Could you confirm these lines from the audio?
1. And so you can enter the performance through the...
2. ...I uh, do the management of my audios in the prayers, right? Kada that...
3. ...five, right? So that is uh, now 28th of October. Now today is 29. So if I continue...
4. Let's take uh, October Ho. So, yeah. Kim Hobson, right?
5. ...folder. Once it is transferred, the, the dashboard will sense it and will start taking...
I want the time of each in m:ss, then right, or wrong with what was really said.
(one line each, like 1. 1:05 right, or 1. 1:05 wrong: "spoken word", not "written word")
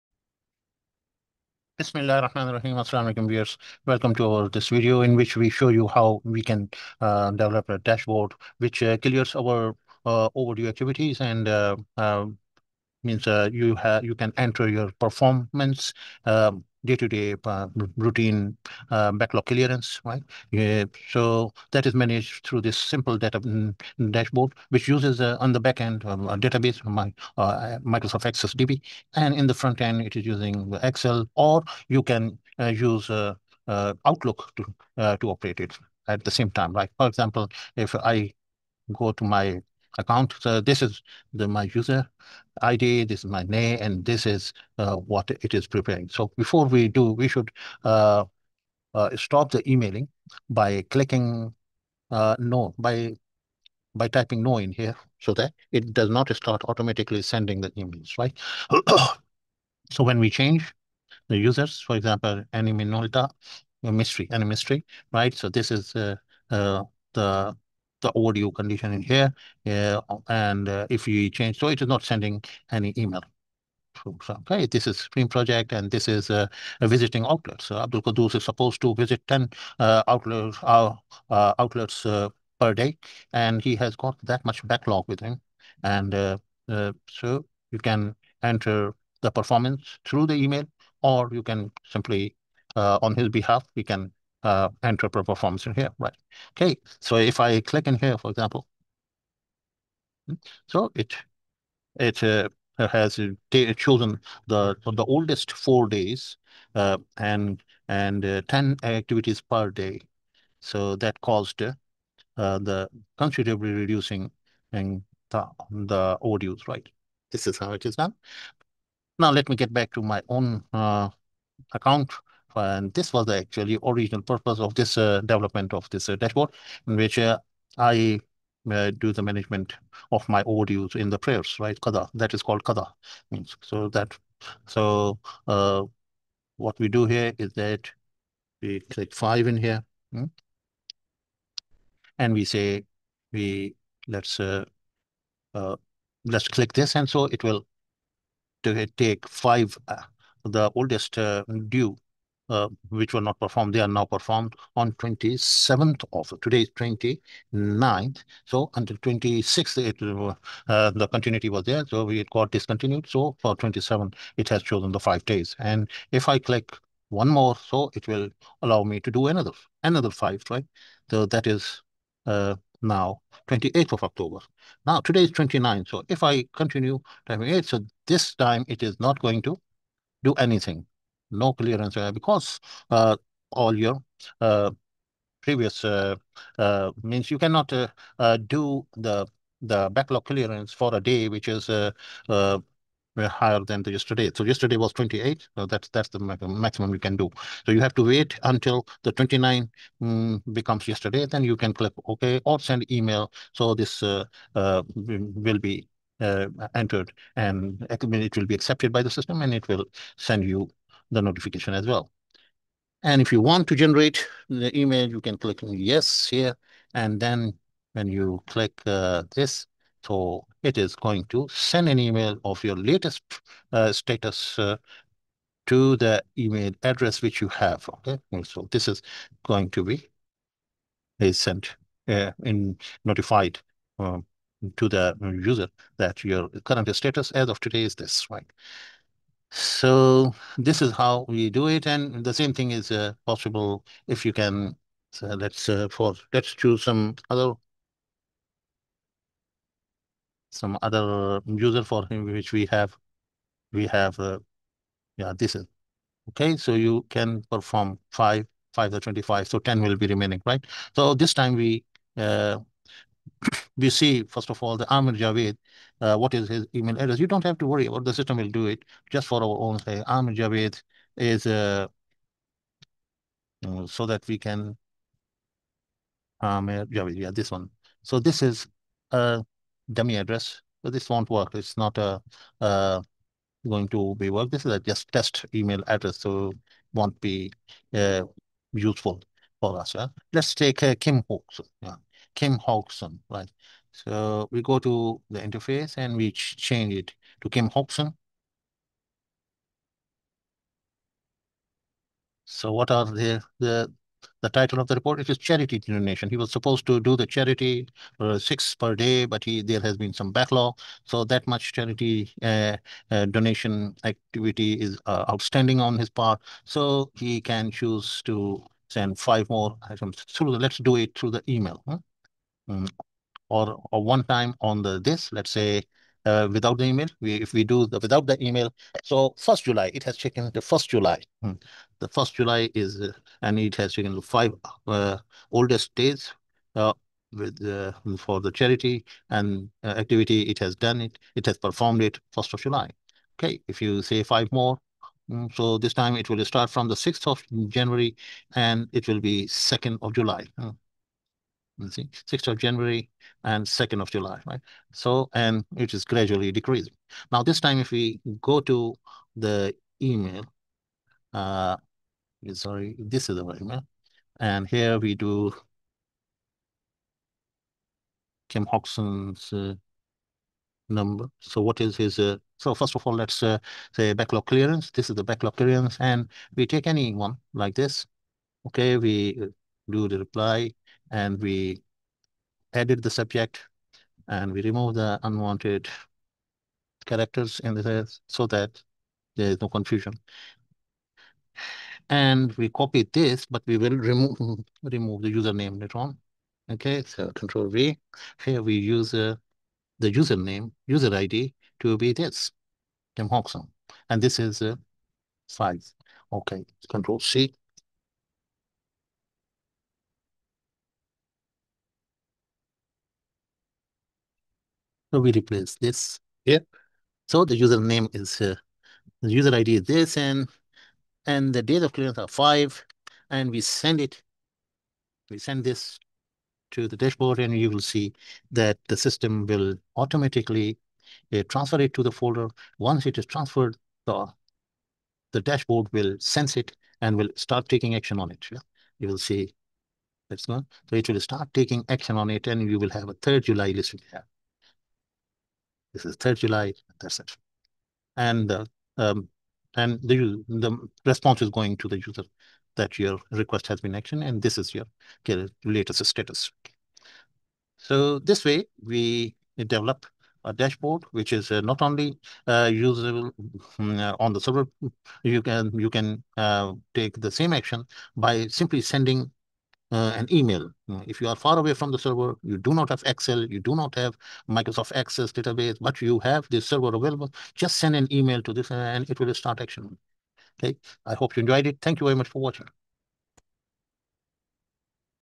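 1. 1:25 right
2. 2:07 right
3. 2:50 right
4. 4:50 wrong: "Kim", not "October"
5. 7:12 right.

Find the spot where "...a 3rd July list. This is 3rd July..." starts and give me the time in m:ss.
7:23.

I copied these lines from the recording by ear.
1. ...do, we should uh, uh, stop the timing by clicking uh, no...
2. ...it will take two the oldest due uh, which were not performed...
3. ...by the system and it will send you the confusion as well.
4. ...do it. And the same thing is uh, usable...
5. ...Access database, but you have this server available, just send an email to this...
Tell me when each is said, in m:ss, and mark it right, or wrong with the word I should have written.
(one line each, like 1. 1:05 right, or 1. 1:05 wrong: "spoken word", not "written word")
1. 0:46 wrong: "emailing", not "timing"
2. 2:27 wrong: "five", not "two"
3. 3:28 wrong: "notification", not "confusion"
4. 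4:01 wrong: "possible", not "usable"
5. 7:54 right.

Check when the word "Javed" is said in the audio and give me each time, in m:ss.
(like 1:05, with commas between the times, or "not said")
4:25, 4:30, 4:36.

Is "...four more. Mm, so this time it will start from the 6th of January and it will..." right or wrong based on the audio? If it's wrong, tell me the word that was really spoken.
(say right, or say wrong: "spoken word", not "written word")
wrong: "five", not "four".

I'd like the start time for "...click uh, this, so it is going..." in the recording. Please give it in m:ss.
3:38.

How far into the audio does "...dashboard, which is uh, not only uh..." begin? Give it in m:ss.
7:40.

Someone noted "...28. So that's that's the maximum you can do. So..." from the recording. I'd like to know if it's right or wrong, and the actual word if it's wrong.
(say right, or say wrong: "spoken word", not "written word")
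right.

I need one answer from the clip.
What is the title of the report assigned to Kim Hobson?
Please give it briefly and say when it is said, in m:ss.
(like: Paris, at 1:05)
charity donation, at 5:05.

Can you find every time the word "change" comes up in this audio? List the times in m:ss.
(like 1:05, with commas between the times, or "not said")
1:00, 1:11, 4:56.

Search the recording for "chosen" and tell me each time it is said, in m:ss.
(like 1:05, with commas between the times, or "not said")
1:43, 2:44.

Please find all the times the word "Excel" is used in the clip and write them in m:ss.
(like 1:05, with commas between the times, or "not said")
0:30, 7:53.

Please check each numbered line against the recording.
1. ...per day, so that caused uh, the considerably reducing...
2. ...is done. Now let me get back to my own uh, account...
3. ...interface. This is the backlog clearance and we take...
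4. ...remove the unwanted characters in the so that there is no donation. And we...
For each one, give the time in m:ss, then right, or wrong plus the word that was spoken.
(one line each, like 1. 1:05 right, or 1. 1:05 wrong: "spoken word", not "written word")
1. 1:49 right
2. 1:57 right
3. 6:14 wrong: "clearance", not "interface"
4. 6:24 wrong: "confusion", not "donation".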